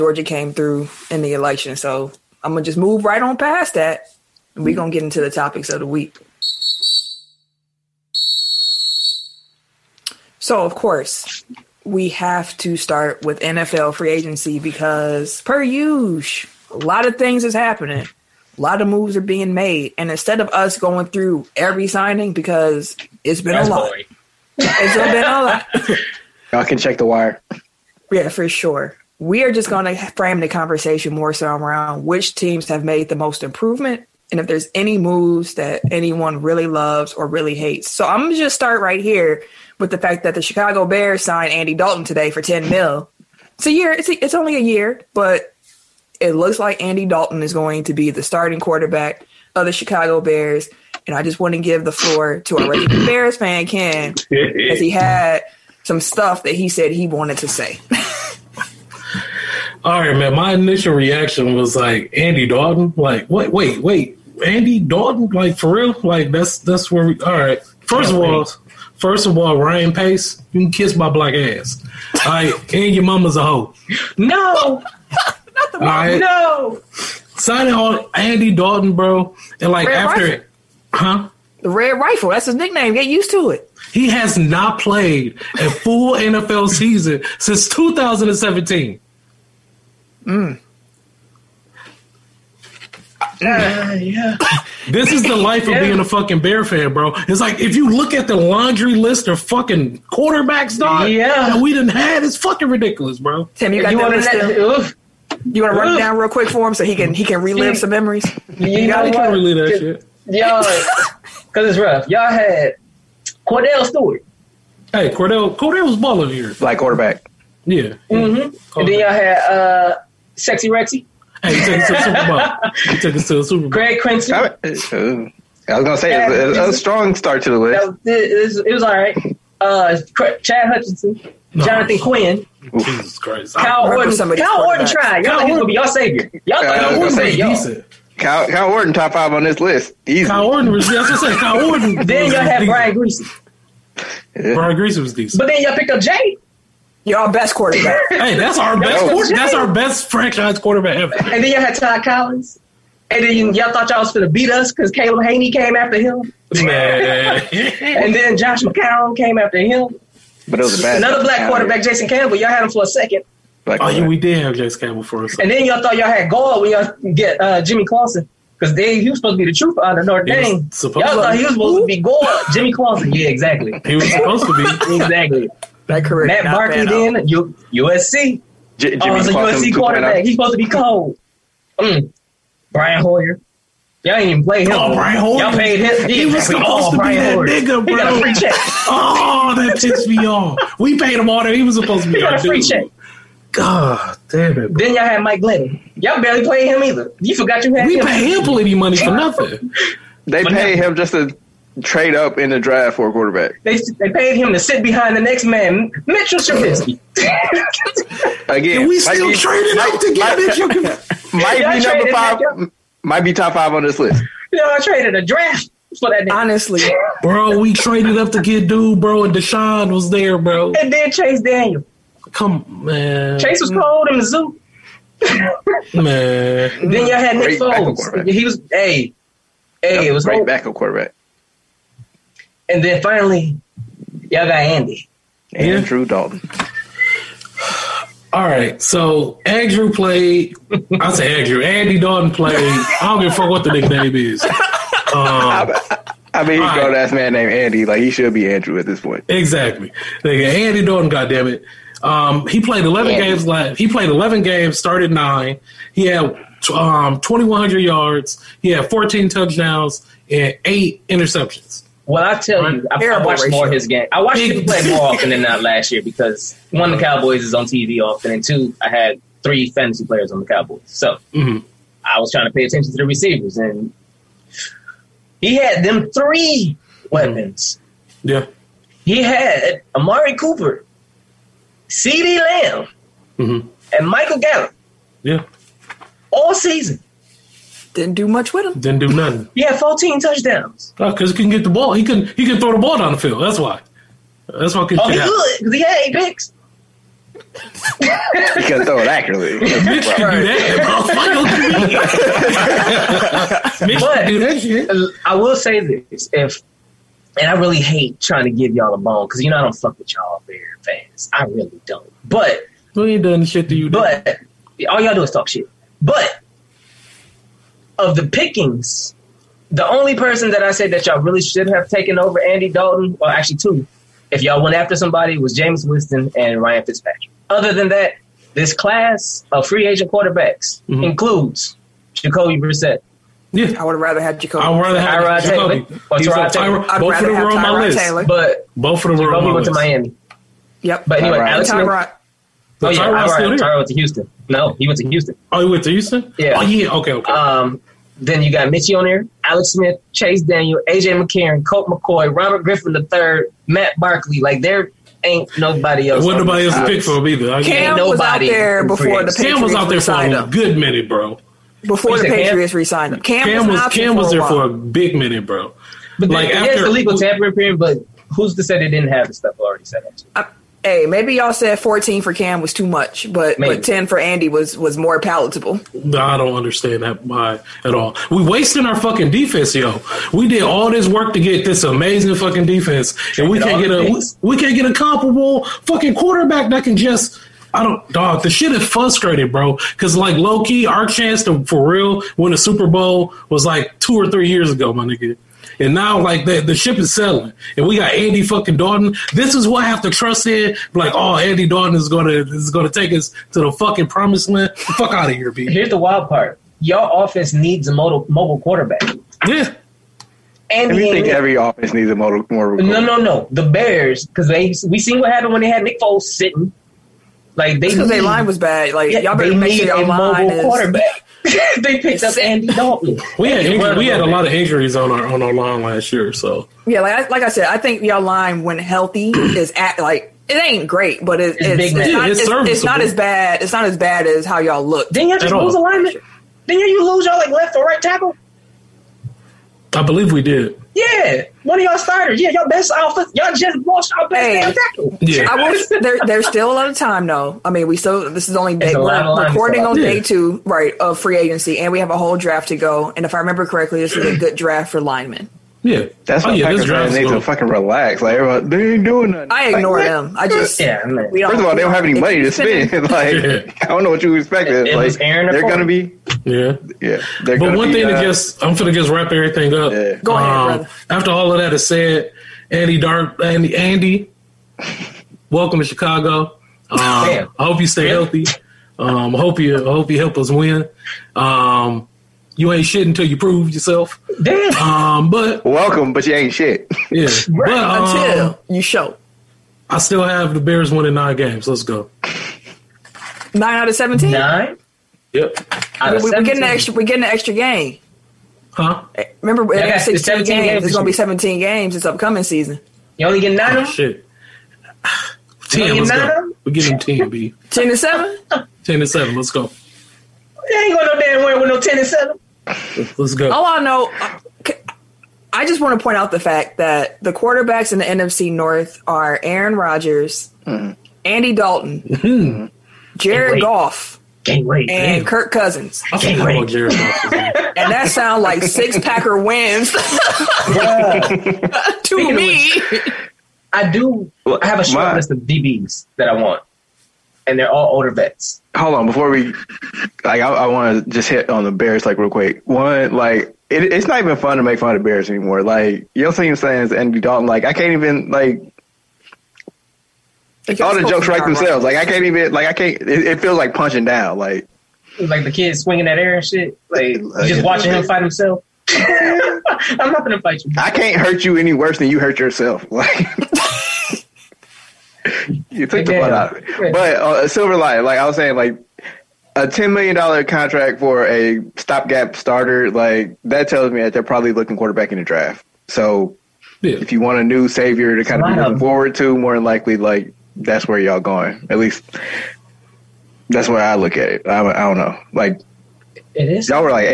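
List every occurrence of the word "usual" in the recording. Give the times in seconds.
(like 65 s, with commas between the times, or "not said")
15 s.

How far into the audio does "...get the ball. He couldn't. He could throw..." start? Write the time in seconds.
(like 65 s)
291 s.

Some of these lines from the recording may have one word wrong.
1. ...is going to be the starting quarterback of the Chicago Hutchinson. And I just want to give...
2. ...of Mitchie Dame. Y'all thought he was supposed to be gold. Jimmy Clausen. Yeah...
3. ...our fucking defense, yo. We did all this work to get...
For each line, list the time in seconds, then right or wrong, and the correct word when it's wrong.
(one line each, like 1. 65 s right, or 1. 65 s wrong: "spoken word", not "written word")
1. 47 s wrong: "Bears", not "Hutchinson"
2. 169 s wrong: "Notre", not "Mitchie"
3. 378 s right.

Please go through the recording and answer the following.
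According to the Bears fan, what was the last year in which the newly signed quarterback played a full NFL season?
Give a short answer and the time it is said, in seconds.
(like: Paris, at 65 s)
2017, at 87 s.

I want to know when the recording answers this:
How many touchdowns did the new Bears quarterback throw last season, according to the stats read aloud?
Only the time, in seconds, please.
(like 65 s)
258 s.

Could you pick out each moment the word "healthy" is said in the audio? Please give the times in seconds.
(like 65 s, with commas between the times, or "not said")
428 s, 478 s.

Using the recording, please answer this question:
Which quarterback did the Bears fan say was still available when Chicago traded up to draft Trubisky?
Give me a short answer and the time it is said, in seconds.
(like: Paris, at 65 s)
Deshaun, at 219 s.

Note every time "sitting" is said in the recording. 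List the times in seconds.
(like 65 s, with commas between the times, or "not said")
416 s.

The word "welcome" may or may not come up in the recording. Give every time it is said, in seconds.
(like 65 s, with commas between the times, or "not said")
475 s, 485 s.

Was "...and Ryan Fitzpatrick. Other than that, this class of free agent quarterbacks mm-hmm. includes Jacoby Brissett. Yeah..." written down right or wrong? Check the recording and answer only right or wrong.
right.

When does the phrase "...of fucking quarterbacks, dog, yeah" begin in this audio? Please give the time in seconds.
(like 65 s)
99 s.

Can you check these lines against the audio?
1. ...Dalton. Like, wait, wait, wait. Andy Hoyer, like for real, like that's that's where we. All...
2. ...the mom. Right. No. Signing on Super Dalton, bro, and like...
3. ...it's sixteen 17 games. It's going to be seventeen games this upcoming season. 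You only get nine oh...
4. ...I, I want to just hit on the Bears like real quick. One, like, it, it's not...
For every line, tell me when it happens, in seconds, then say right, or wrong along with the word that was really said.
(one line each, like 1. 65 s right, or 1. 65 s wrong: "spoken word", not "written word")
1. 62 s wrong: "Dalton", not "Hoyer"
2. 75 s wrong: "Andy", not "Super"
3. 499 s right
4. 540 s right.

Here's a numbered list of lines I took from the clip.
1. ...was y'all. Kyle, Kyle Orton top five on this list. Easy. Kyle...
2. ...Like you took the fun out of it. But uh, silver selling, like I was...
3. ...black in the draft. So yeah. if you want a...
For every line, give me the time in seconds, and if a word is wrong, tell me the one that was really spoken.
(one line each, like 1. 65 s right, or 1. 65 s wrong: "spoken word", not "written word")
1. 137 s right
2. 562 s wrong: "lining", not "selling"
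3. 574 s wrong: "quarterback", not "black".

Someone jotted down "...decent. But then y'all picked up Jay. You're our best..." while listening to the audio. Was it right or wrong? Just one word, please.
right.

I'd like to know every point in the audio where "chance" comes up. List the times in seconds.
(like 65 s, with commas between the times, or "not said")
391 s.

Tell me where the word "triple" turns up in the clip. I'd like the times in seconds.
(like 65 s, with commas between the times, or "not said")
not said.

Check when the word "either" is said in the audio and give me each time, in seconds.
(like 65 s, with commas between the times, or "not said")
196 s, 357 s.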